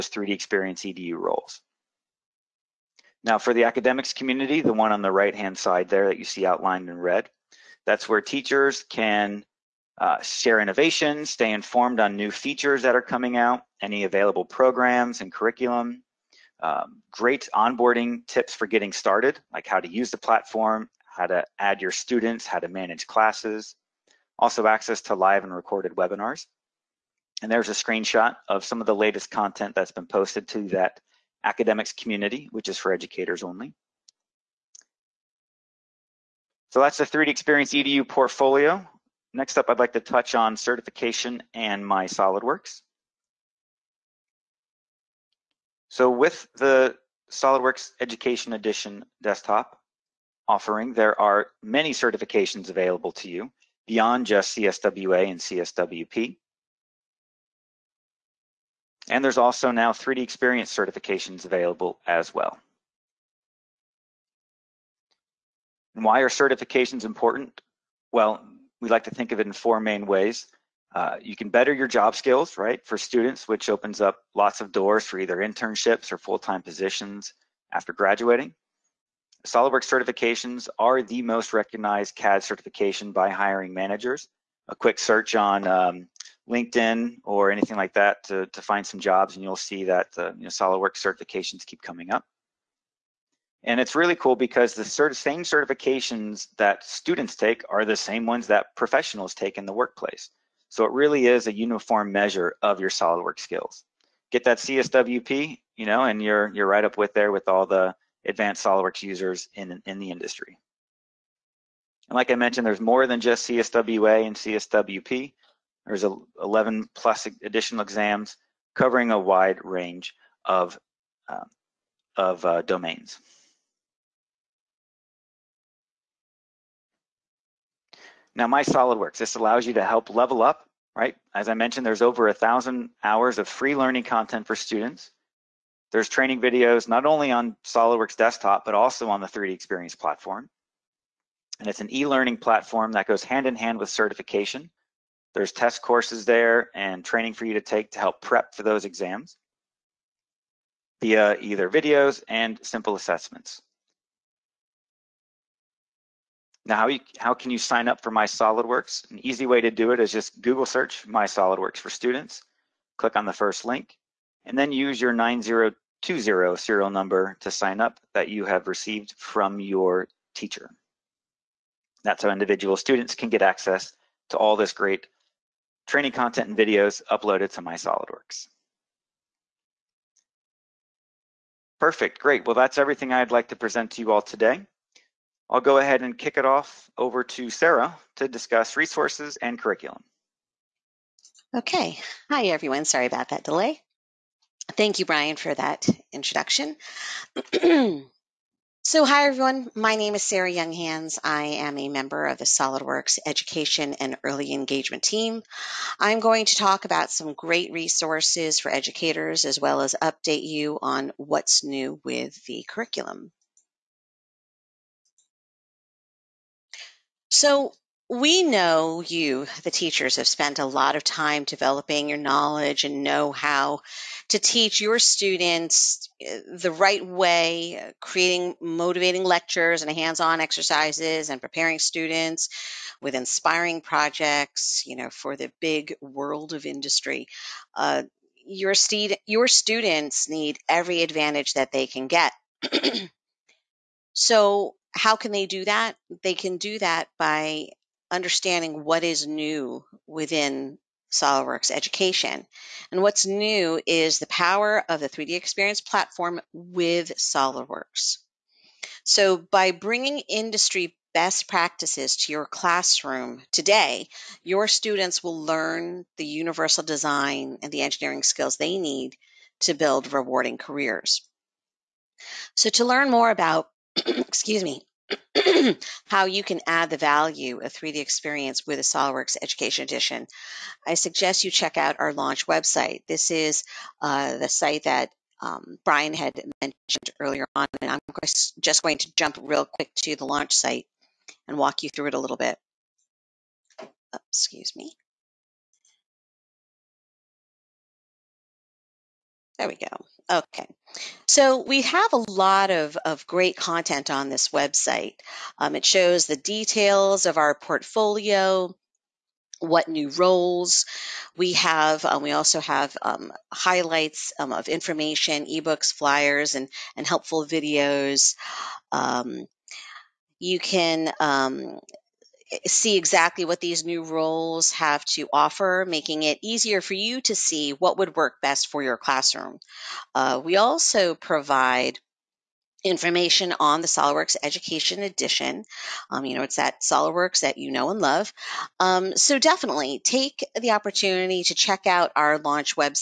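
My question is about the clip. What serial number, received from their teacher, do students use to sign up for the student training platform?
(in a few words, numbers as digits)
9020.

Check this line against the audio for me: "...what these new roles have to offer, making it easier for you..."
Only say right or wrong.
right.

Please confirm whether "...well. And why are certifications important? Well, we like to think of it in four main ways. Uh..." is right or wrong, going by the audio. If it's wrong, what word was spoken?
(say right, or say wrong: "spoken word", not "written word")
right.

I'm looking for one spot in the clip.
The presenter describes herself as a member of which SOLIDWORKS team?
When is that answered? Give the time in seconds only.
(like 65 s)
202 s.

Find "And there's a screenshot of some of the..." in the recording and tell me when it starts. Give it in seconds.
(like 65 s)
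27 s.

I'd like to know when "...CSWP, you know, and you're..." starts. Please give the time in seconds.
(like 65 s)
104 s.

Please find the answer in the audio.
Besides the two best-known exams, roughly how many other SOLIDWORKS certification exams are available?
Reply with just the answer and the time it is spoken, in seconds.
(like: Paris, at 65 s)
11, at 116 s.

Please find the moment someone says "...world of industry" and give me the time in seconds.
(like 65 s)
236 s.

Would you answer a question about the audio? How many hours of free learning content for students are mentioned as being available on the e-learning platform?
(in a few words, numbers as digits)
over 1000.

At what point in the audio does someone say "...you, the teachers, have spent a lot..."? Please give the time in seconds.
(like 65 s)
219 s.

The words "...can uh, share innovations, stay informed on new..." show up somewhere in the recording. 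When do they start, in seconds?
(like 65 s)
8 s.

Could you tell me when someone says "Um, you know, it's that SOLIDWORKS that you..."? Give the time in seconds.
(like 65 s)
336 s.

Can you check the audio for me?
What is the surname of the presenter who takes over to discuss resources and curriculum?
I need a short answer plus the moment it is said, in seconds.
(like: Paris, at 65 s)
Younghands, at 200 s.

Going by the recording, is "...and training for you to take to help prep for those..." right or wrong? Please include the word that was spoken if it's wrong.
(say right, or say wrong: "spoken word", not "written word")
right.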